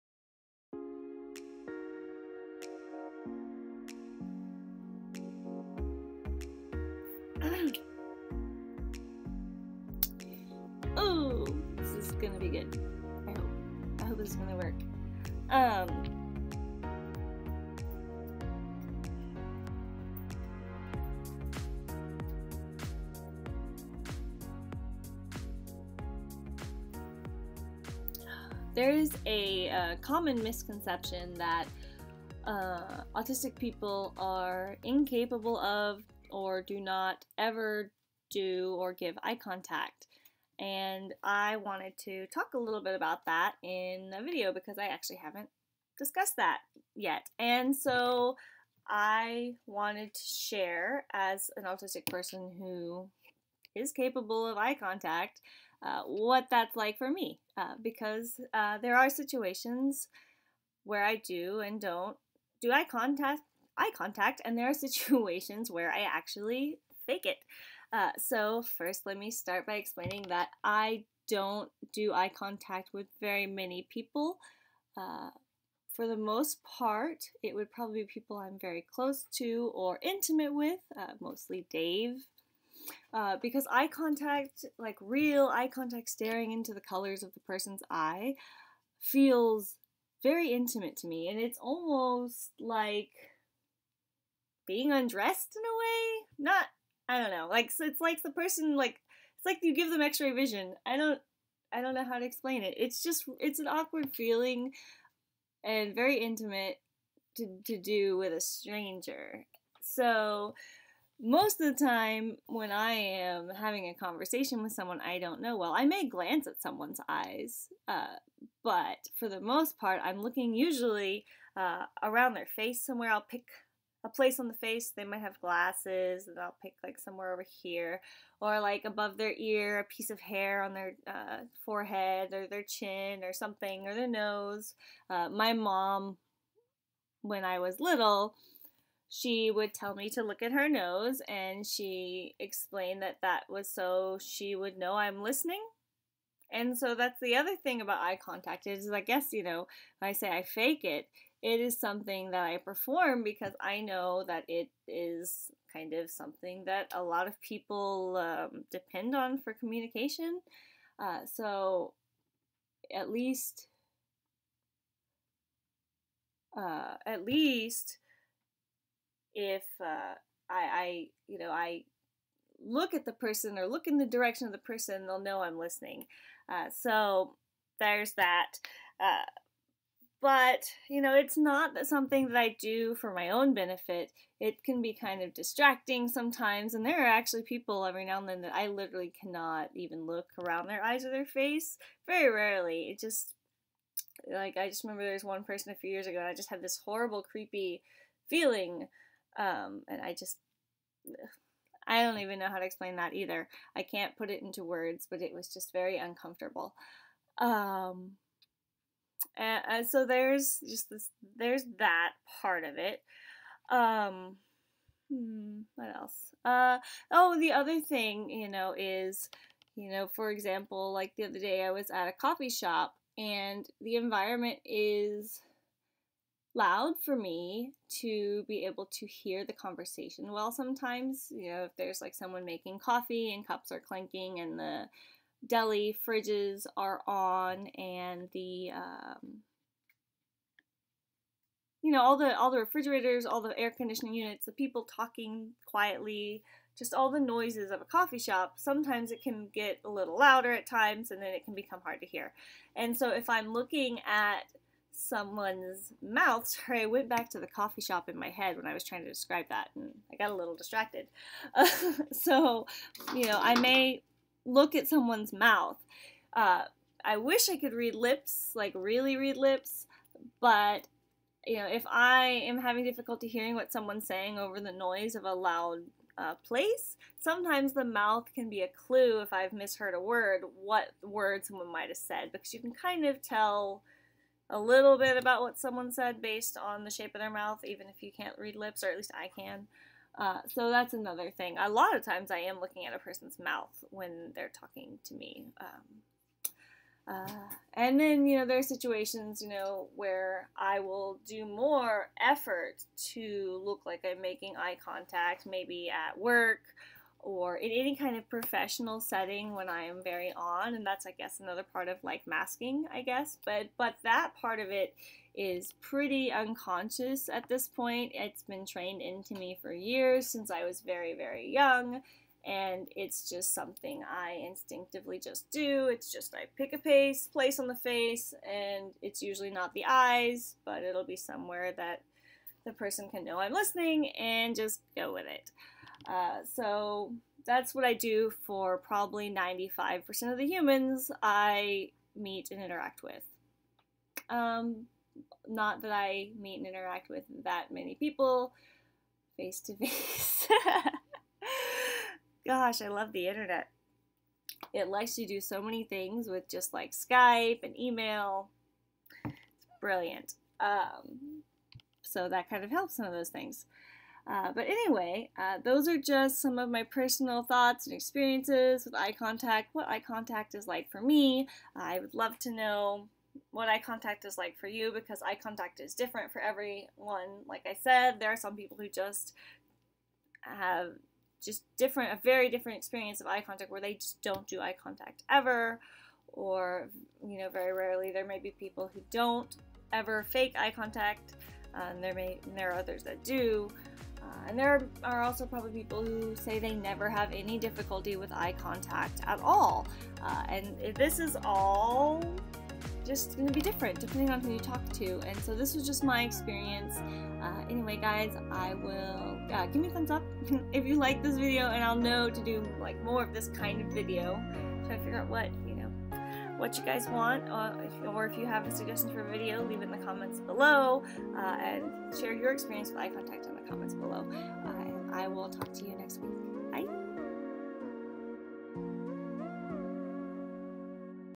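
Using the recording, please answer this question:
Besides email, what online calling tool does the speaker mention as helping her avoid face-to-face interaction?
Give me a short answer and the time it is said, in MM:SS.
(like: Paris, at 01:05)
Skype, at 05:56.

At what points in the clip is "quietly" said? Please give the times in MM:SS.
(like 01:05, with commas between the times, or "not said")
04:05.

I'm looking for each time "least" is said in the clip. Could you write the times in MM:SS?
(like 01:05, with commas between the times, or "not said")
02:43, 02:47, 04:48.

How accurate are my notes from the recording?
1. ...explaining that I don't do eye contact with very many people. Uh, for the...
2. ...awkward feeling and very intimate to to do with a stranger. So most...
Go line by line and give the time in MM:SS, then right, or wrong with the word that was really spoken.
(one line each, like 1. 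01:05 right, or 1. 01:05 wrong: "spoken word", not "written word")
1. 01:09 right
2. 01:43 right.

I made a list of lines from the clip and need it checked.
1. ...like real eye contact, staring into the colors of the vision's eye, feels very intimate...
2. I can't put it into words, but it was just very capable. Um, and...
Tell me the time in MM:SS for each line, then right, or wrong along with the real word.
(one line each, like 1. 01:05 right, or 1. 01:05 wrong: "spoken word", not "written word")
1. 01:24 wrong: "person", not "vision"
2. 03:23 wrong: "uncomfortable", not "capable".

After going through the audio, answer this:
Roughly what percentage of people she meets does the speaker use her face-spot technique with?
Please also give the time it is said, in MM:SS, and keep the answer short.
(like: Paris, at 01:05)
95%, at 05:39.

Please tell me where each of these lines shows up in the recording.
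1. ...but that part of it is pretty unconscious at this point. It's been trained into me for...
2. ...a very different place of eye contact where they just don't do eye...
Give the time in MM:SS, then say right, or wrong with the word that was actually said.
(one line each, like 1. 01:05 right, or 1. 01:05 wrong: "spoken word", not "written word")
1. 05:13 right
2. 06:22 wrong: "experience", not "place".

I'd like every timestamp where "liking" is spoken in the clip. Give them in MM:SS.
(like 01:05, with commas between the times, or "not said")
not said.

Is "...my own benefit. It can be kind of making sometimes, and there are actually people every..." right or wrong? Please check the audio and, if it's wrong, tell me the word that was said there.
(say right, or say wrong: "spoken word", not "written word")
wrong: "distracting", not "making".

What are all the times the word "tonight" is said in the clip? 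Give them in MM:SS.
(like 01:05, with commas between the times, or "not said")
not said.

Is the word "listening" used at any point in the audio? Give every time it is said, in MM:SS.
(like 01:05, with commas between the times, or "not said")
02:25, 02:55, 05:33.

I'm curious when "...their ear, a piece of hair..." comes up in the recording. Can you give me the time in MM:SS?
02:09.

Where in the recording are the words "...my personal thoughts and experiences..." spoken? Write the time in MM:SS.
06:06.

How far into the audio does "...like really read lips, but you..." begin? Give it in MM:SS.
04:28.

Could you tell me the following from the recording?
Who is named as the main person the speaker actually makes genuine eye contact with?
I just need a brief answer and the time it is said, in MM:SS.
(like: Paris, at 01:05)
Dave, at 01:21.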